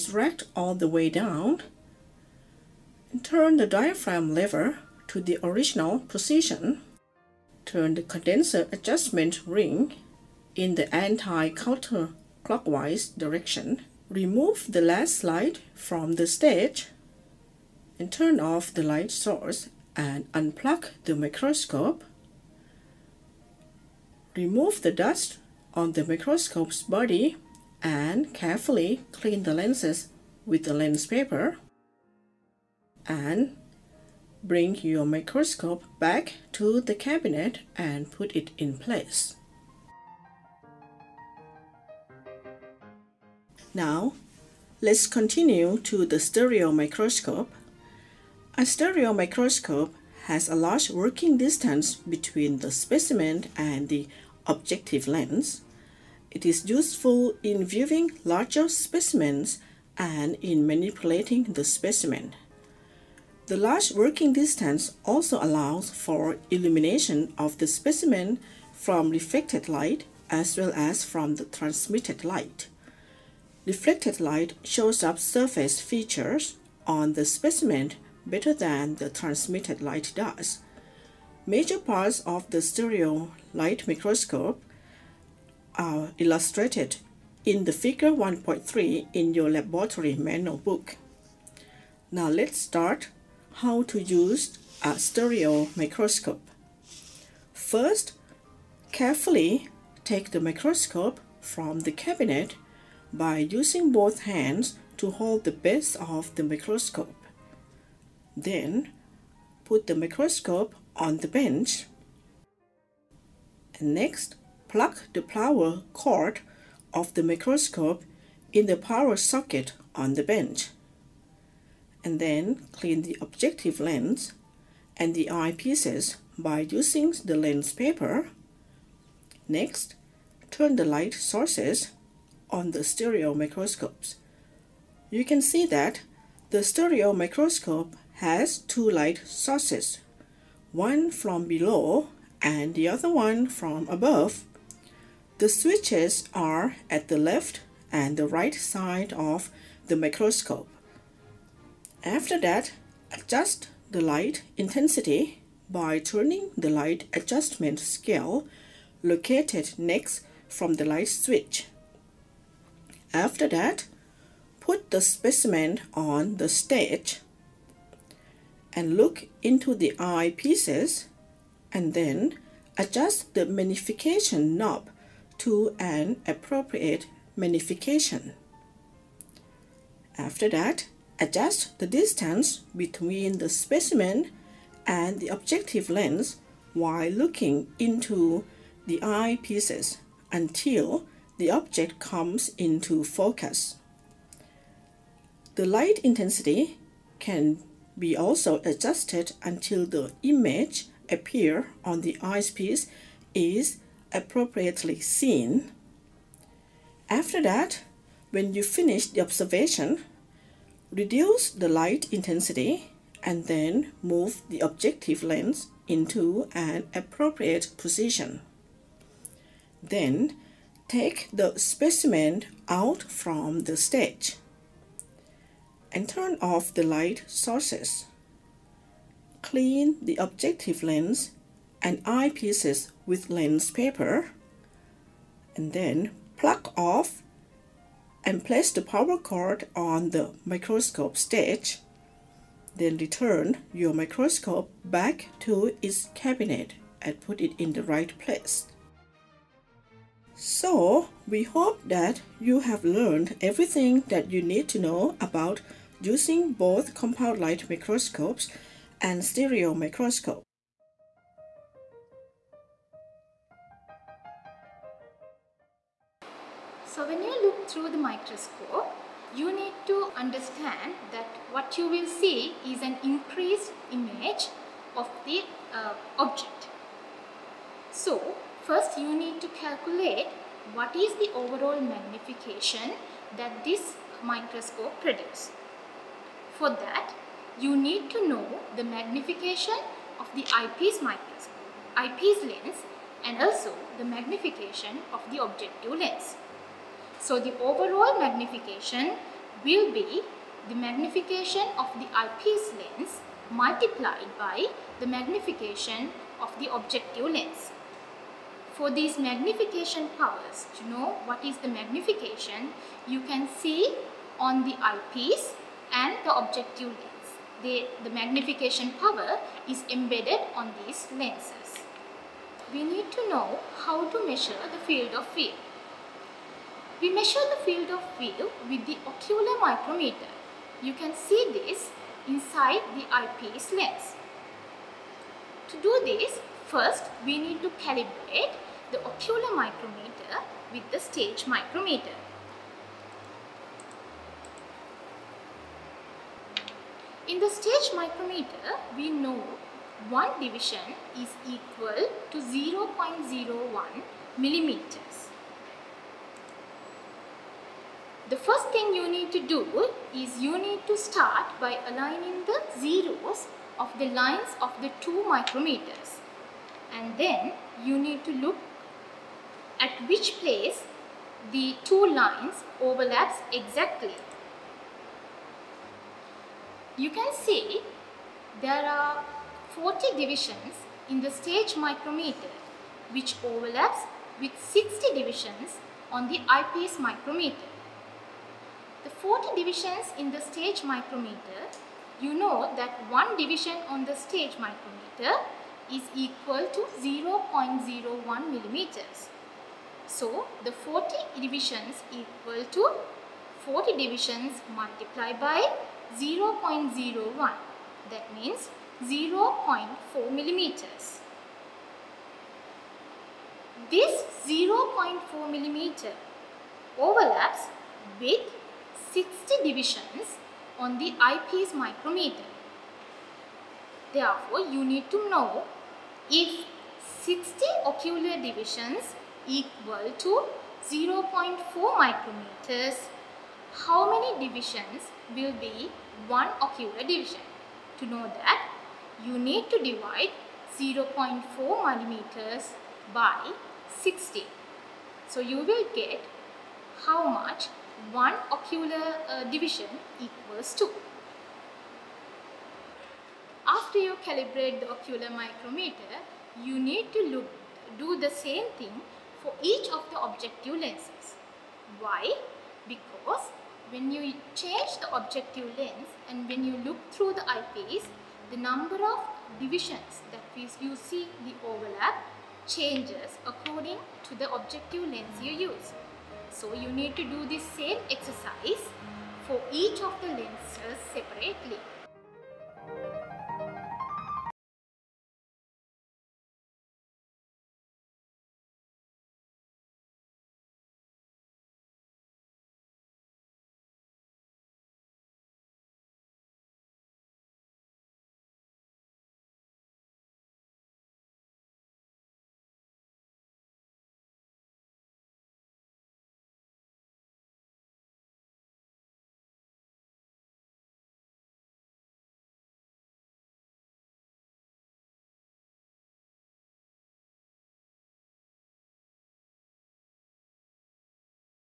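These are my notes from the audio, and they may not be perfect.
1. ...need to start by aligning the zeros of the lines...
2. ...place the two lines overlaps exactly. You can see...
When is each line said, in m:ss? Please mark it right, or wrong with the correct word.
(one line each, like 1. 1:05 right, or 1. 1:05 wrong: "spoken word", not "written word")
1. 6:00 right
2. 6:10 right.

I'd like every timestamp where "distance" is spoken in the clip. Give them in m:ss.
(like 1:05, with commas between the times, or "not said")
0:51, 1:04, 3:01.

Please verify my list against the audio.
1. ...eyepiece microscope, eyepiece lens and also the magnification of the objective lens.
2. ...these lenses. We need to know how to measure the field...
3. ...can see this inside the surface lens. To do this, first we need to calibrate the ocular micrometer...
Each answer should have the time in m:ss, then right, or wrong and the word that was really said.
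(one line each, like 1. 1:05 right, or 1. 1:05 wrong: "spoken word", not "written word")
1. 4:50 right
2. 5:20 right
3. 5:30 wrong: "eyepiece", not "surface".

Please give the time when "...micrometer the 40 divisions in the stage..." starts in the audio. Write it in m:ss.
6:26.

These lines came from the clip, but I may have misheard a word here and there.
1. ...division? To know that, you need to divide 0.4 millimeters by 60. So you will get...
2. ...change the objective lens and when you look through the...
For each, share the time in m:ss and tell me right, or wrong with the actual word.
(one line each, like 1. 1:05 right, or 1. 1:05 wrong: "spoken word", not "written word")
1. 7:16 right
2. 7:44 right.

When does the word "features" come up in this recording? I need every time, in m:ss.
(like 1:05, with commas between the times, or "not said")
1:15.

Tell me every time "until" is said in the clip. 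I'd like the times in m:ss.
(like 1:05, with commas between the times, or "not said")
3:10, 3:19.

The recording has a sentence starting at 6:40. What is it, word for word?
So, the 40 divisions equal to 40 divisions multiplied by 0.01.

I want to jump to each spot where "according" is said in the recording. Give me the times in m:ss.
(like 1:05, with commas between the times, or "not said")
7:53.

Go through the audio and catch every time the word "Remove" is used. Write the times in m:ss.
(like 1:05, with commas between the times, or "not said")
0:14, 0:24.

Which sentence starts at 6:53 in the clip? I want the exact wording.
This 0.4 millimeter overlaps with 60 divisions on the eyepiece micrometer.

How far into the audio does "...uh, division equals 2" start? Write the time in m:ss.
7:29.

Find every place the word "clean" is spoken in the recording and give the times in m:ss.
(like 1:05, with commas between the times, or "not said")
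0:29, 2:02, 3:49.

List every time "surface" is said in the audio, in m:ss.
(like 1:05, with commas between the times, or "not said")
1:15.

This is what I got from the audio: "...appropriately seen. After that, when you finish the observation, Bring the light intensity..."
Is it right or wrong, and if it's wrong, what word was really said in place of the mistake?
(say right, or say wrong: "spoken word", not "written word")
wrong: "Reduce", not "Bring".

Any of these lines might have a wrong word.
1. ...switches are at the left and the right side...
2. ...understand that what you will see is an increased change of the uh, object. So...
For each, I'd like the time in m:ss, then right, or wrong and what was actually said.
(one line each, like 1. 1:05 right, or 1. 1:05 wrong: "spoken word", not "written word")
1. 2:25 right
2. 4:30 wrong: "image", not "change".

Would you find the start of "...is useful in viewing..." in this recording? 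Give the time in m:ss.
0:56.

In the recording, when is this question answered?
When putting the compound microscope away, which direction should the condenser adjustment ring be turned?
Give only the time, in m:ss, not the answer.
0:10.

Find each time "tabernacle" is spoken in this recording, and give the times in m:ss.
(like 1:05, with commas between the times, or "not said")
not said.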